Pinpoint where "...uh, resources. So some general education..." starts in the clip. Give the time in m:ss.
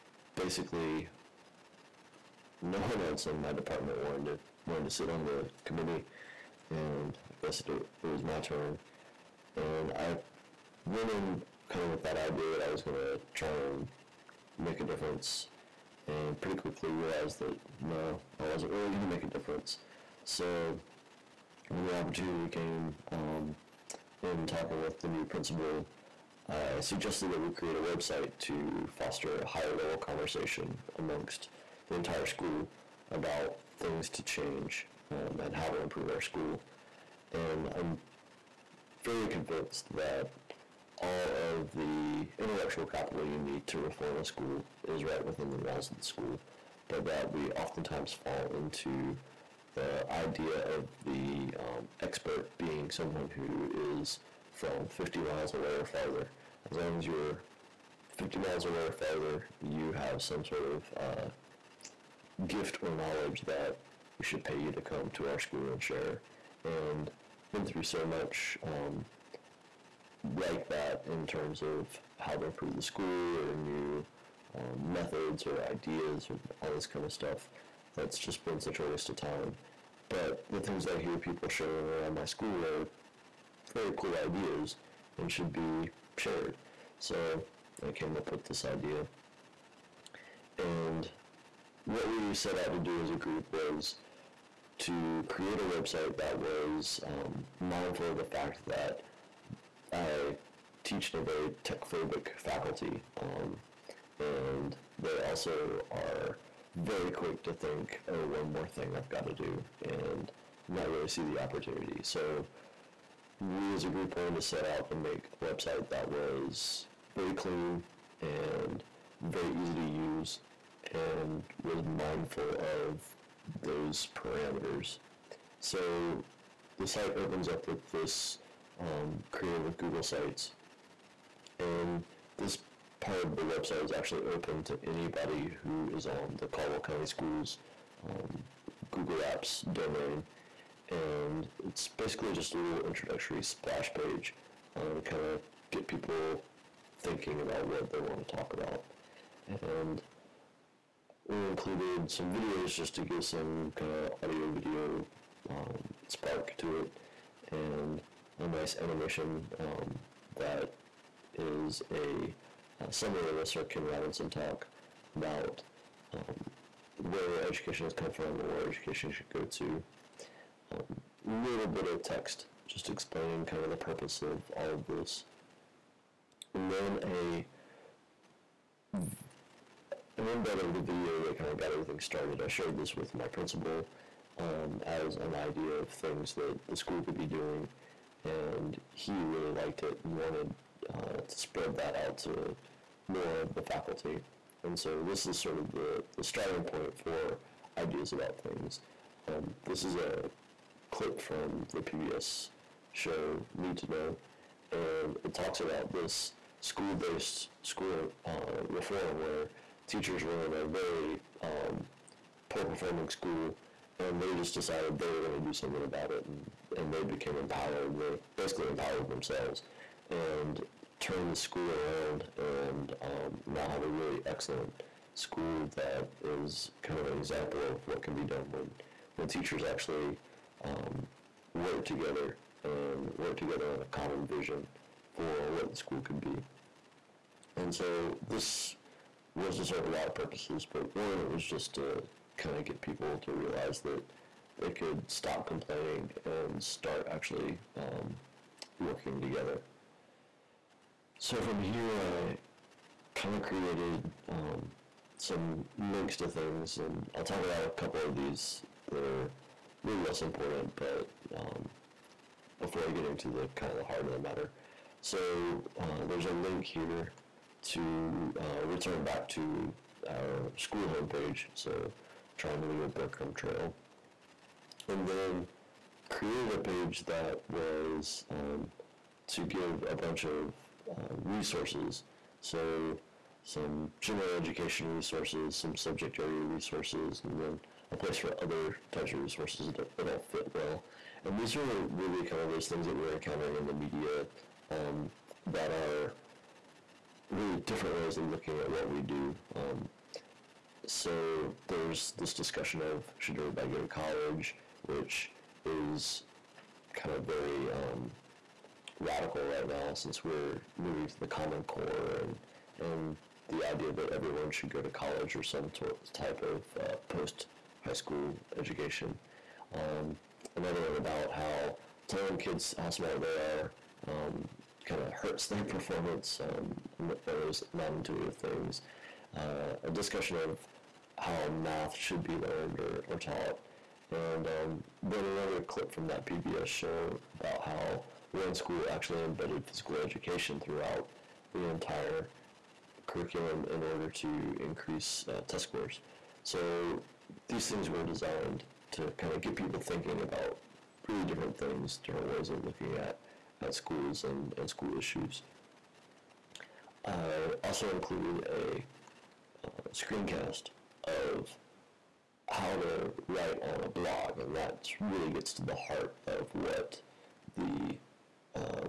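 4:40.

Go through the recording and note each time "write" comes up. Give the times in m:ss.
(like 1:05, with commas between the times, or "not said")
6:03.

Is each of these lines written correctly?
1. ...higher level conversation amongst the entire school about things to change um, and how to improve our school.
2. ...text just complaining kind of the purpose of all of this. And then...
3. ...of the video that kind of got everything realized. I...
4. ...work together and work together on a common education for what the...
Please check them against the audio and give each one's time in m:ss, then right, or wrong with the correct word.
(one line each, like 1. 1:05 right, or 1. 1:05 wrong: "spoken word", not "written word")
1. 0:29 right
2. 2:52 wrong: "explaining", not "complaining"
3. 3:00 wrong: "started", not "realized"
4. 3:51 wrong: "vision", not "education".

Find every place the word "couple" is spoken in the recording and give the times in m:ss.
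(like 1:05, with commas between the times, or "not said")
4:17.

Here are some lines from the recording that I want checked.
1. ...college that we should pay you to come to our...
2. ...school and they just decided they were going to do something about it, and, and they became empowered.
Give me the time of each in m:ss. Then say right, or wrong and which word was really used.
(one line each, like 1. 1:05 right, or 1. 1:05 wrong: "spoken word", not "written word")
1. 1:02 wrong: "knowledge", not "college"
2. 3:33 right.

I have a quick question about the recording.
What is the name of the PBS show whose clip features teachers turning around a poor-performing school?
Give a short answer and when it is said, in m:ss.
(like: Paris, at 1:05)
Need to Know, at 3:23.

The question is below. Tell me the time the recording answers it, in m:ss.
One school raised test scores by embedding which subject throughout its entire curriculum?
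5:39.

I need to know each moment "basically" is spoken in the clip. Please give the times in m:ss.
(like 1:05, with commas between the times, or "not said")
0:00, 2:21, 3:38.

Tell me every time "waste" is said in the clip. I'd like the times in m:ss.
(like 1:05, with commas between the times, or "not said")
1:18.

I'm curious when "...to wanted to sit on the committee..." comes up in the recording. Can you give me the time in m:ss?
0:04.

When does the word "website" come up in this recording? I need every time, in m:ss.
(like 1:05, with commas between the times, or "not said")
0:27, 1:35, 1:55, 2:13.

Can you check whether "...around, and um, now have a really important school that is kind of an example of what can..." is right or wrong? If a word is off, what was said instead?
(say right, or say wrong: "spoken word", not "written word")
wrong: "excellent", not "important".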